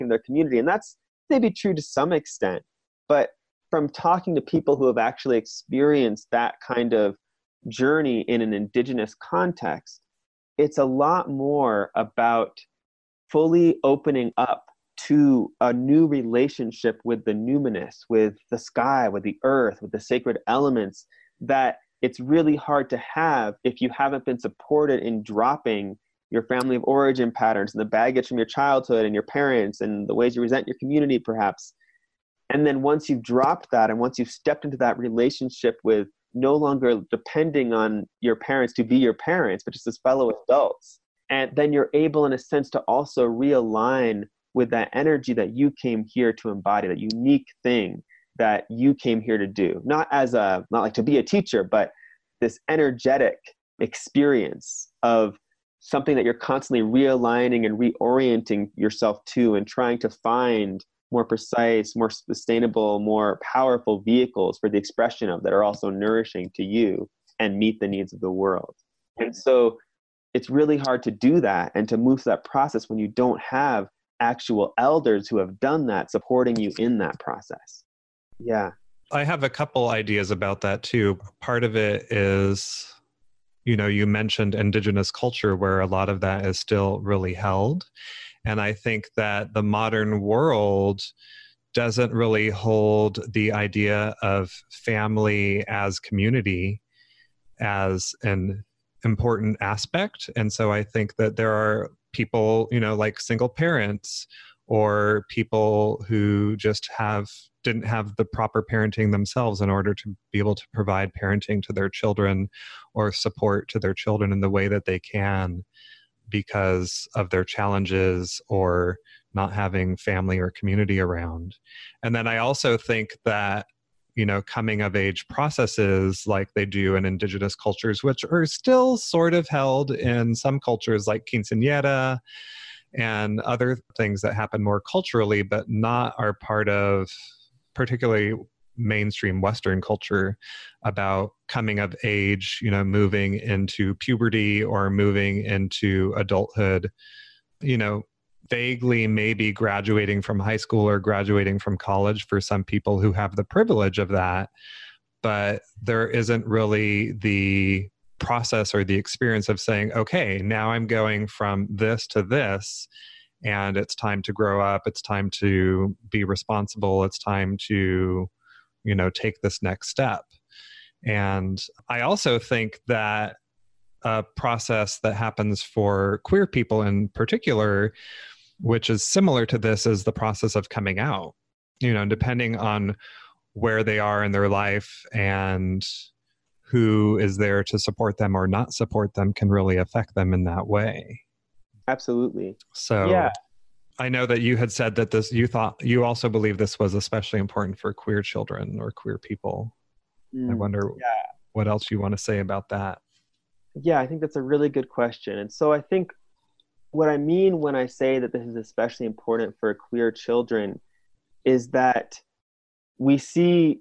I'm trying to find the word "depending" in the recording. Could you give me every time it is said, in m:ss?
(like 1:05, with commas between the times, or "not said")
0:37, 3:02.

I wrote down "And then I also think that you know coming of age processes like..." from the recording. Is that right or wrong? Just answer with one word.
right.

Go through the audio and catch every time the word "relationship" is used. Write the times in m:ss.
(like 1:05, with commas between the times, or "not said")
0:16, 0:34.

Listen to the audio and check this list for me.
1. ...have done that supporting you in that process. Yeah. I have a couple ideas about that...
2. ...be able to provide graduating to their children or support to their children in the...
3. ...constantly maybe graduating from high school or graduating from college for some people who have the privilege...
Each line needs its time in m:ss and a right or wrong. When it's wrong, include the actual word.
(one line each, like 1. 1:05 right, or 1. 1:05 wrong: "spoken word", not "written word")
1. 1:15 right
2. 1:50 wrong: "parenting", not "graduating"
3. 2:28 wrong: "vaguely", not "constantly".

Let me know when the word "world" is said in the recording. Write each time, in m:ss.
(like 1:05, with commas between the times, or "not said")
1:08, 1:30.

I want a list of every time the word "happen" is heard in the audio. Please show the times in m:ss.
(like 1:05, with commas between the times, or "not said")
2:14, 2:55.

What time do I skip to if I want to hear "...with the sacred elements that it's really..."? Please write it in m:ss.
0:19.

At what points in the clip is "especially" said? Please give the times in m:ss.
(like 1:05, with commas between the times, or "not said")
3:16, 3:28.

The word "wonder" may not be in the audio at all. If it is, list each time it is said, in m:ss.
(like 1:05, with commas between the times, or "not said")
3:20.